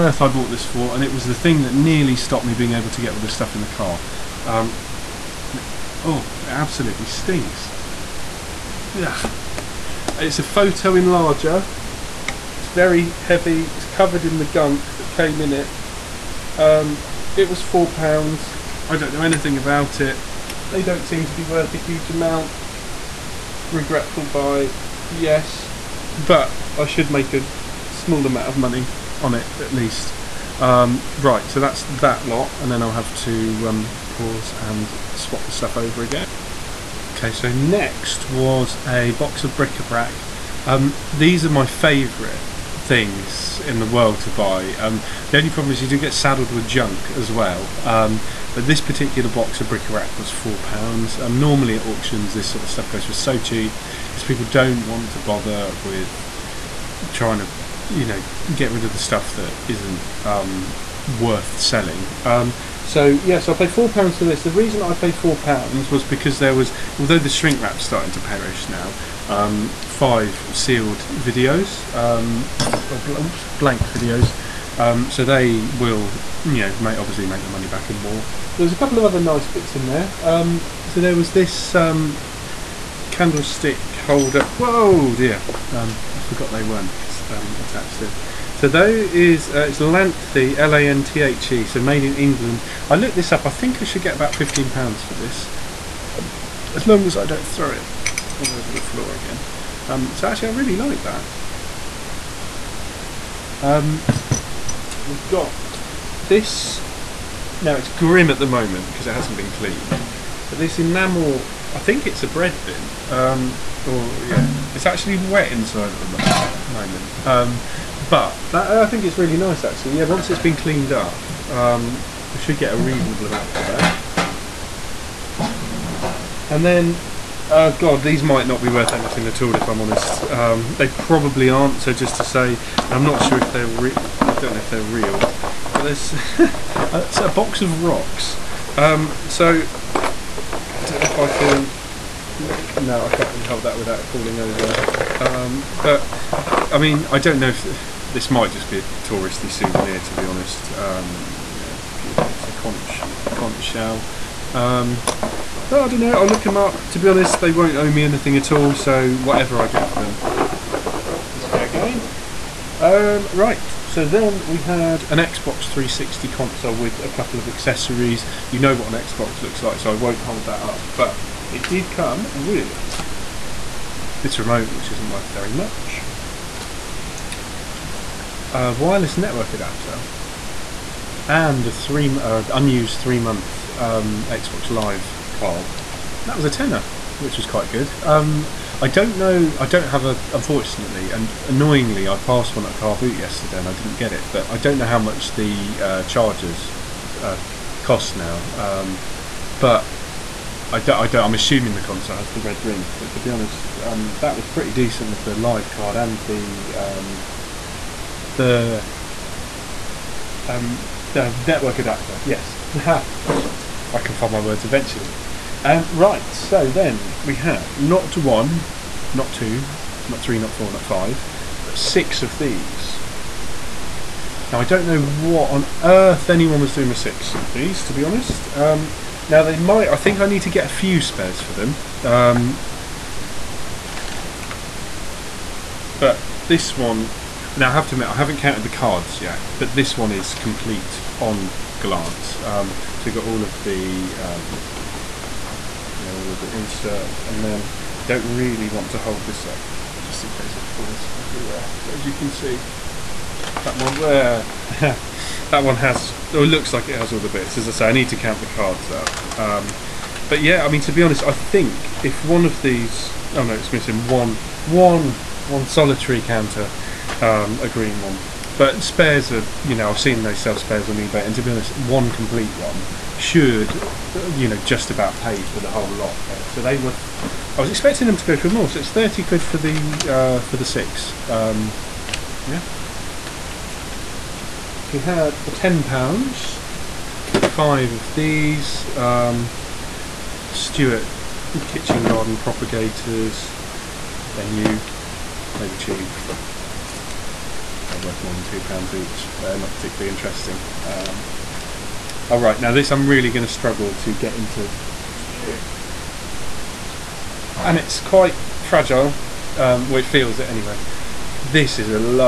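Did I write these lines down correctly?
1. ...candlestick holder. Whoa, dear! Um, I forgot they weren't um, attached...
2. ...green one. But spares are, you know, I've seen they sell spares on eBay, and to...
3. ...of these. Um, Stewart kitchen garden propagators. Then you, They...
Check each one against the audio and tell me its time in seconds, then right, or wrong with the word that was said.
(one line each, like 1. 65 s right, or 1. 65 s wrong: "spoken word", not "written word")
1. 83 s right
2. 267 s right
3. 287 s right.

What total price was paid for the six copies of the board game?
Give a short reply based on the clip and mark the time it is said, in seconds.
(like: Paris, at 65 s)
£30, at 278 s.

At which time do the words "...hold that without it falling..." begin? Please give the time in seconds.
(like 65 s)
143 s.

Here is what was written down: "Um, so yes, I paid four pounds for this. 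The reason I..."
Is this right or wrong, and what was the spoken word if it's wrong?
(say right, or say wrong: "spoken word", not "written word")
right.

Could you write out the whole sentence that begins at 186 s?
That was a tenner which was quite good.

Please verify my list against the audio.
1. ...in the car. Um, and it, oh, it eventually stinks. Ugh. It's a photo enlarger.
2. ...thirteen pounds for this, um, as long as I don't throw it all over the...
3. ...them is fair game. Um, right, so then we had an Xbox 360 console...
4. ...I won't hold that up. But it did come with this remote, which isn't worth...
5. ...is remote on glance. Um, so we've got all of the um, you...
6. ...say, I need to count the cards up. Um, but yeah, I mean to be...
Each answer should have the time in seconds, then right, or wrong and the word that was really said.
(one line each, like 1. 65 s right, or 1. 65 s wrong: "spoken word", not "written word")
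1. 3 s wrong: "absolutely", not "eventually"
2. 94 s wrong: "fifteen", not "thirteen"
3. 160 s right
4. 169 s right
5. 240 s wrong: "complete", not "remote"
6. 257 s right.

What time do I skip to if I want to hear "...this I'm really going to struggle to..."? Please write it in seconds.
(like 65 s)
302 s.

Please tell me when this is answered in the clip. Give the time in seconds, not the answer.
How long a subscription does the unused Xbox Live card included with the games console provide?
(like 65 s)
183 s.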